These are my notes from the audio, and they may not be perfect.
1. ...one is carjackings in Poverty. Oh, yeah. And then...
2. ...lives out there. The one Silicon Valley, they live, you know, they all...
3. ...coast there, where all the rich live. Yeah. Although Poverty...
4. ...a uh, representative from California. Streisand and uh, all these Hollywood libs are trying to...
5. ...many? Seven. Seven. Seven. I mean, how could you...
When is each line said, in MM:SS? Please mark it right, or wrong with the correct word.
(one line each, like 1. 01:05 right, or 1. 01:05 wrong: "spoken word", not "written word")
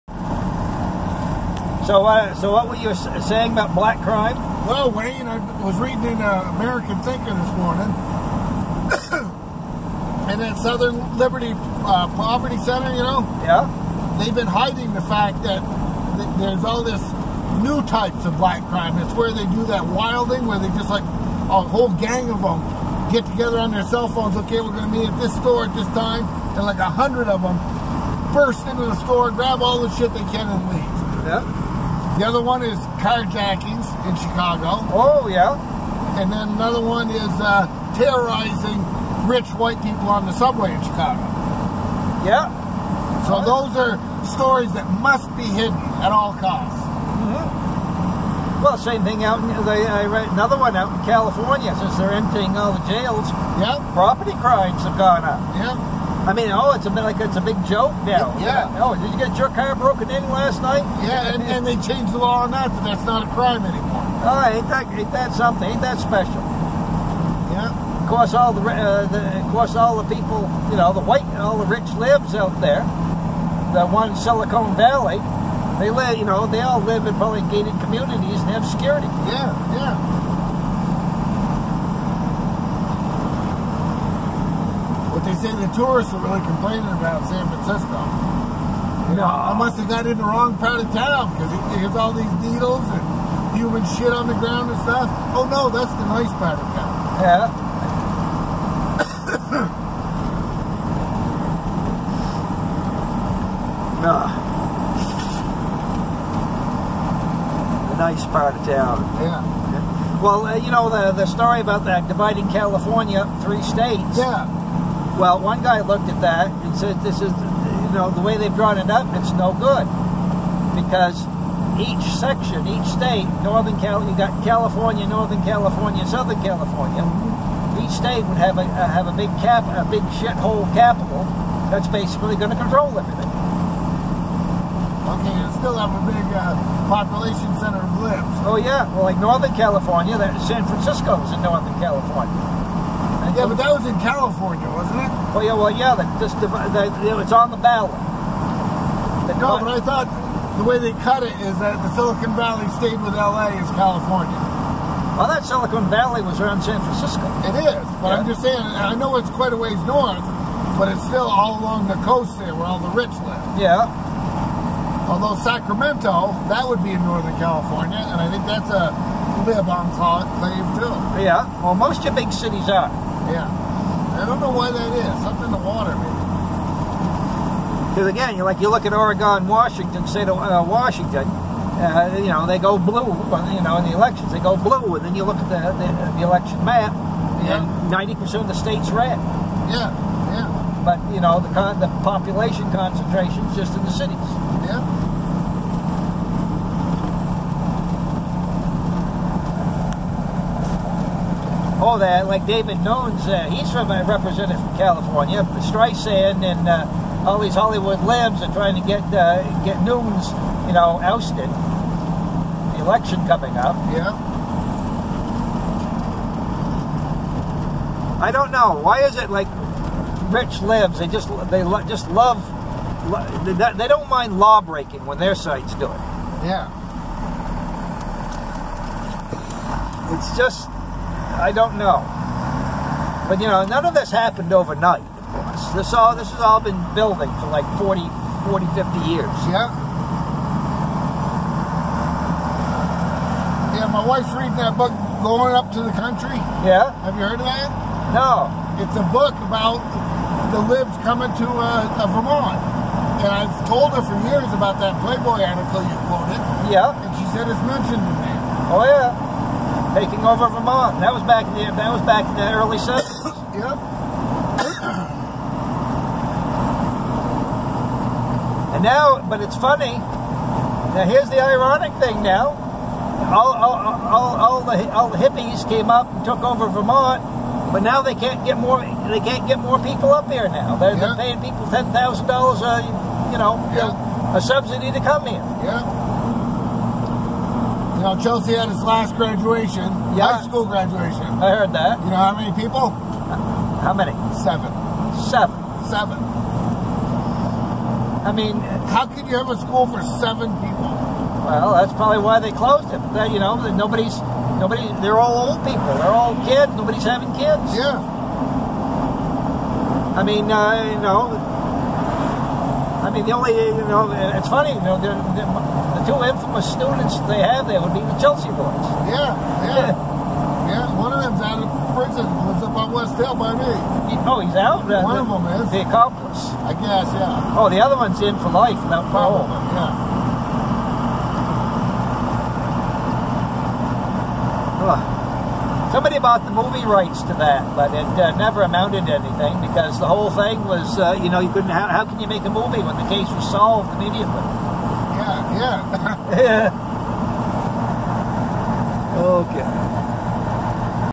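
1. 00:32 wrong: "Chicago", not "Poverty"
2. 01:11 right
3. 02:42 wrong: "Sacramento", not "Poverty"
4. 03:23 right
5. 04:53 right.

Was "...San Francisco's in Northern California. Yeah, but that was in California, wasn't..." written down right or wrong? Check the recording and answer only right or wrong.
right.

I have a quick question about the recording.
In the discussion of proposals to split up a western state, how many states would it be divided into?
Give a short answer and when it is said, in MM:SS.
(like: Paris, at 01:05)
3, at 01:53.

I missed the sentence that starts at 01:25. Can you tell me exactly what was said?
But they say the tourists are really complaining about San Francisco.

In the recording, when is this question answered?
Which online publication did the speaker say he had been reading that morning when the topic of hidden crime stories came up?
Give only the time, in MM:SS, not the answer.
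00:06.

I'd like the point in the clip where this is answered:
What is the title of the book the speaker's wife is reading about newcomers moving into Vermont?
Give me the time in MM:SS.
04:05.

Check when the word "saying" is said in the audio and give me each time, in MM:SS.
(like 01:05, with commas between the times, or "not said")
00:03, 02:38.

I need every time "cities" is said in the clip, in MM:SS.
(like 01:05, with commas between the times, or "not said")
02:52, 03:13.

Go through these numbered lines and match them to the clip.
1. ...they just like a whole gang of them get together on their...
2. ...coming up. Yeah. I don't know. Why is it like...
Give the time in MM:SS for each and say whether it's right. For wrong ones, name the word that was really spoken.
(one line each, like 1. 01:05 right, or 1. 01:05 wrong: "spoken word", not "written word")
1. 00:20 right
2. 03:33 right.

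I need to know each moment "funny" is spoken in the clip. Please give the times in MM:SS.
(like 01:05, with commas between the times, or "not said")
04:29, 05:14.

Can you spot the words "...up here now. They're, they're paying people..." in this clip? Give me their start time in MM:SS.
04:40.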